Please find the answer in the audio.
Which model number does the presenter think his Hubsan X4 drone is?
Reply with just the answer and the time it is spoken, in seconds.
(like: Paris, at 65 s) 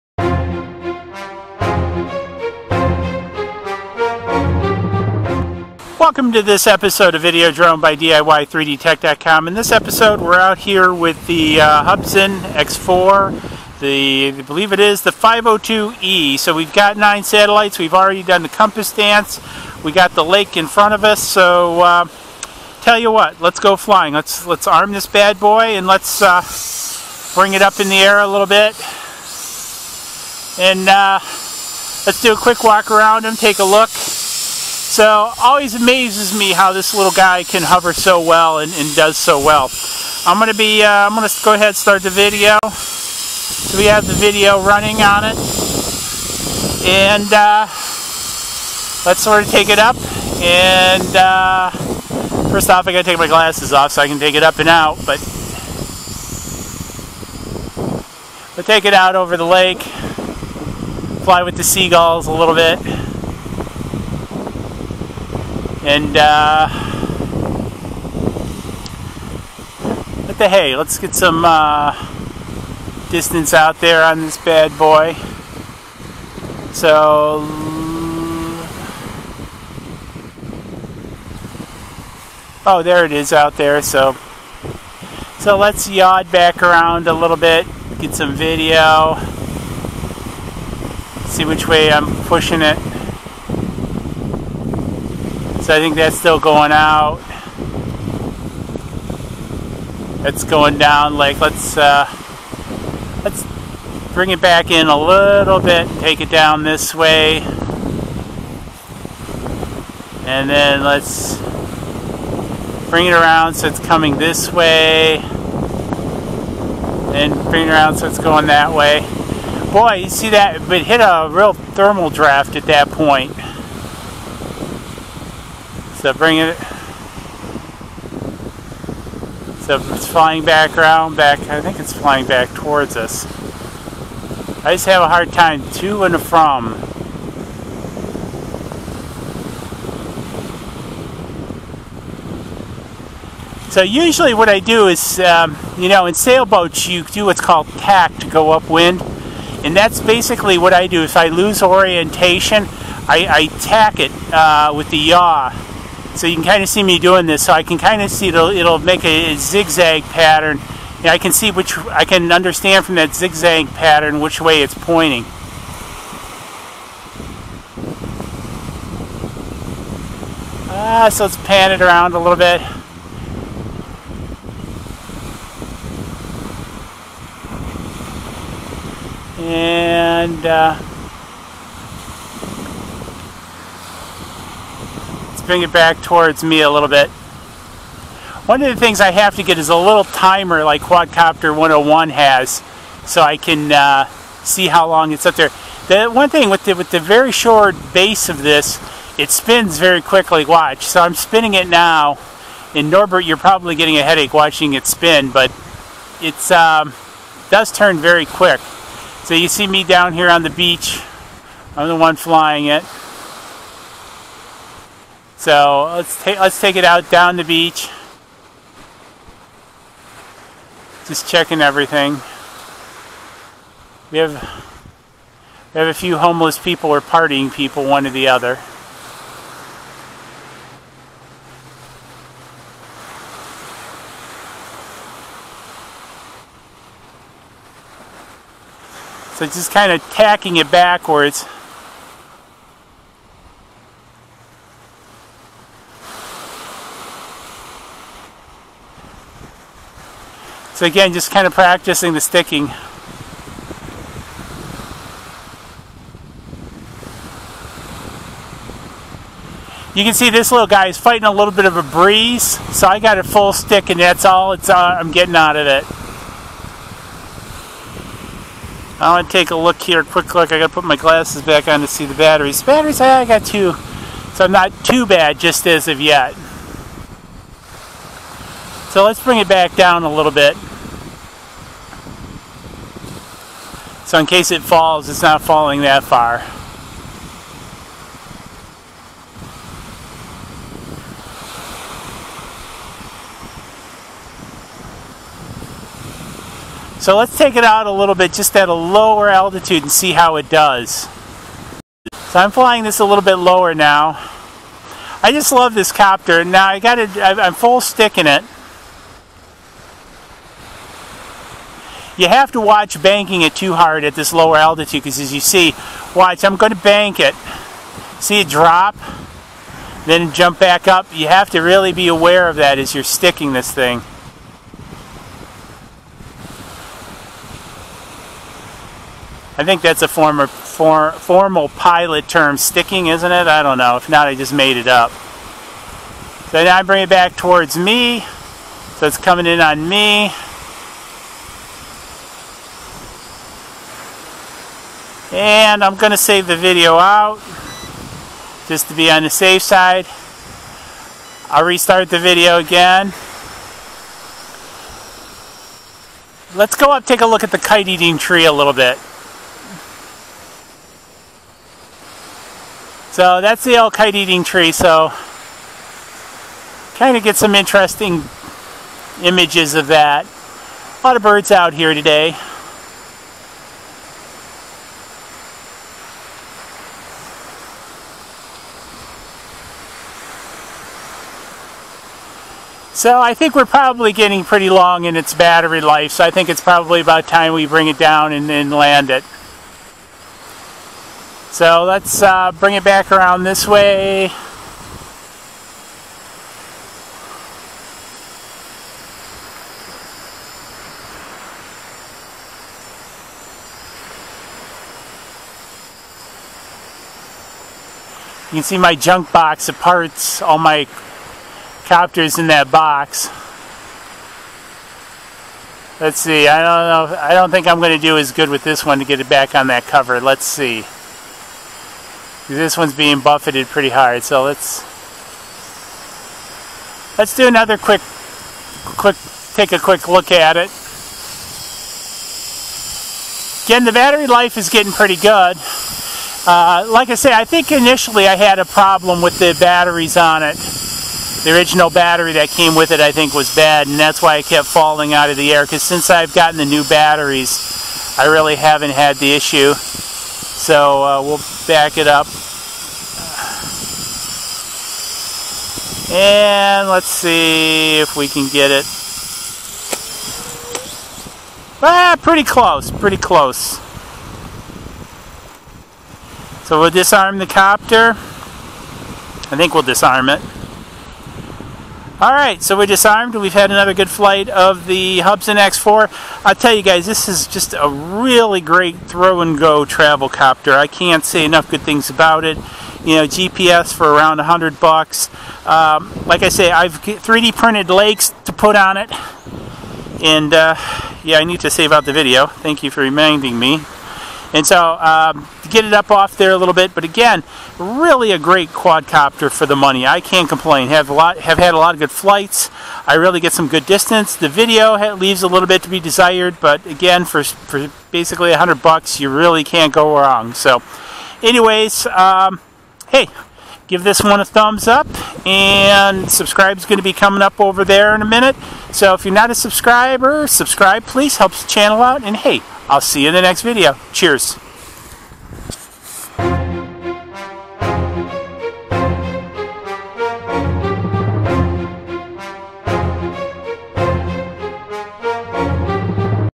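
502E, at 15 s.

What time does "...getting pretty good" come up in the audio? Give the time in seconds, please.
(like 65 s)
434 s.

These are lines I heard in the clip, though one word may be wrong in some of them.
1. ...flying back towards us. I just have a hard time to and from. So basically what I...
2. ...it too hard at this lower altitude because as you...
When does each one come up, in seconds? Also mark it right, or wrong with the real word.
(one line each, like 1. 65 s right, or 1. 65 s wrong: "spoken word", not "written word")
1. 131 s wrong: "usually", not "basically"
2. 313 s right.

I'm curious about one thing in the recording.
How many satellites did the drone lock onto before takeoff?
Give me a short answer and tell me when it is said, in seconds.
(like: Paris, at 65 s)
9, at 16 s.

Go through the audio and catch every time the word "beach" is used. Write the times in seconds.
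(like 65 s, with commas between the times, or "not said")
210 s, 217 s.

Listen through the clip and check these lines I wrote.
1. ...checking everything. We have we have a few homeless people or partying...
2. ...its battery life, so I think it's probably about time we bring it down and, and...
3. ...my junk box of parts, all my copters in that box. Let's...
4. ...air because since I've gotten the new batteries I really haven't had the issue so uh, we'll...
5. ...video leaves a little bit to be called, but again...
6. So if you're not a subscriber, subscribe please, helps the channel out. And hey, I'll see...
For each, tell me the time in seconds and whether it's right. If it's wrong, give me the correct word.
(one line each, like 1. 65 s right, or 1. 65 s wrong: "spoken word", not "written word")
1. 221 s right
2. 385 s right
3. 408 s right
4. 445 s right
5. 504 s wrong: "desired", not "called"
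6. 518 s right.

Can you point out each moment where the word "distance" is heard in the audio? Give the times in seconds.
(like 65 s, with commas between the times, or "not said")
73 s, 503 s.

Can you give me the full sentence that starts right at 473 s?
We've had another good flight of the Hubsan X4.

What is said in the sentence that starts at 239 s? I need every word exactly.
So just kind of tacking it backwards.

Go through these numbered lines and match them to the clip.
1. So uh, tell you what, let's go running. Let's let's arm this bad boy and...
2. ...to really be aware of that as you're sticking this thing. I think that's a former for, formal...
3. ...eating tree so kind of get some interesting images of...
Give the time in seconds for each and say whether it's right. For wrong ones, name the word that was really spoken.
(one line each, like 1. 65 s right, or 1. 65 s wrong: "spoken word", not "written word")
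1. 21 s wrong: "flying", not "running"
2. 321 s right
3. 364 s right.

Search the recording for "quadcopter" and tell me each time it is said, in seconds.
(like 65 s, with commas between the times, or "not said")
190 s, 498 s.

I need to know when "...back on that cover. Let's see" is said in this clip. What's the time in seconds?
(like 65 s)
419 s.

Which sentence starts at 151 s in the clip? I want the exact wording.
If I lose orientation, I, I tack it uh, with the yaw so you can kind of see me doing this.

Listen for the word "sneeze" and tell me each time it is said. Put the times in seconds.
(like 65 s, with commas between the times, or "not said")
not said.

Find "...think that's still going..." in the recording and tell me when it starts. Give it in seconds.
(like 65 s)
95 s.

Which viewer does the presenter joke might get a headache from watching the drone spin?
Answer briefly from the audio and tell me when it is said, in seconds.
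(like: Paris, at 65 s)
Norbert, at 202 s.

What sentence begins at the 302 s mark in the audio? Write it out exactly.
So I'm flying this a little bit lower now.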